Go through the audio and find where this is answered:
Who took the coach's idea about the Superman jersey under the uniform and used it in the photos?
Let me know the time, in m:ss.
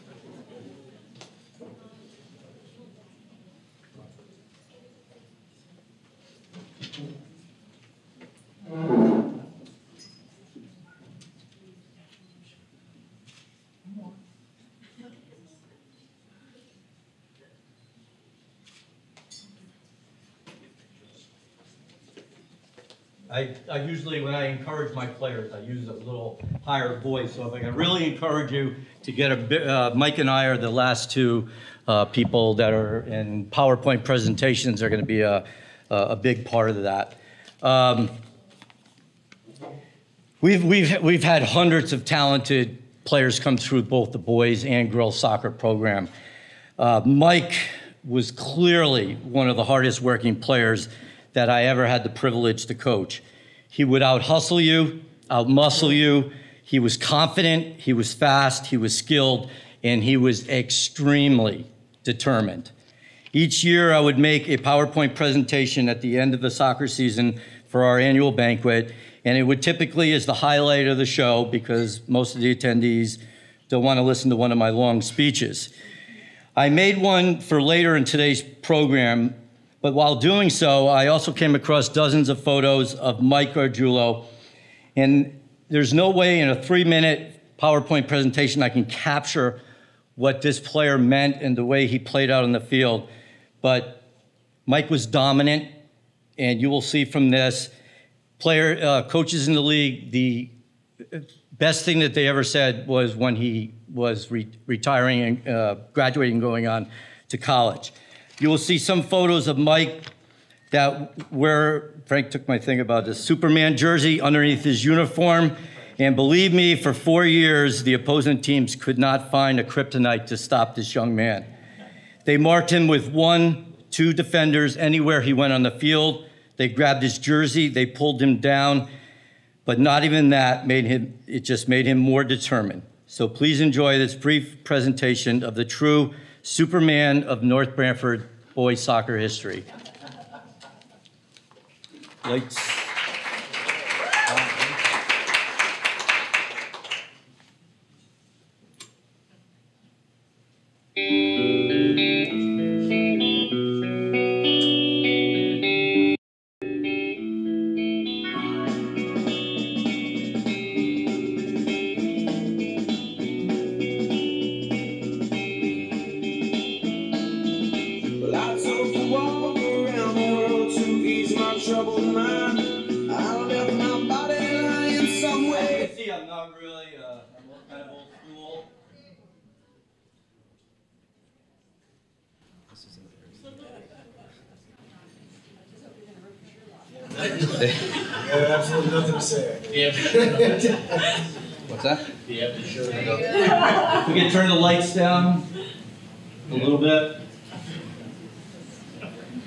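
1:52.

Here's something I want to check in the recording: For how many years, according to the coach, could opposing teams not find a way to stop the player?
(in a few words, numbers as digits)
4.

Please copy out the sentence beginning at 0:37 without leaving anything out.
Um, we've, we've, we've had hundreds of talented players come through both the boys and girls soccer program.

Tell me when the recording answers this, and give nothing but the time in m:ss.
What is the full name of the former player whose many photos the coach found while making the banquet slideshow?
1:23.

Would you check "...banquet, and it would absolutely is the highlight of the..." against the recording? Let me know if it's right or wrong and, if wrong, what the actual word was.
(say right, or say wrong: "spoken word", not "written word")
wrong: "typically", not "absolutely".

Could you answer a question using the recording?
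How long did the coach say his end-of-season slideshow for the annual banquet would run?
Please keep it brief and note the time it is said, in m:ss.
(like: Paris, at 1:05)
3 minutes, at 1:26.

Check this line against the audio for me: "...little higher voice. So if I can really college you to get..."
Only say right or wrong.
wrong.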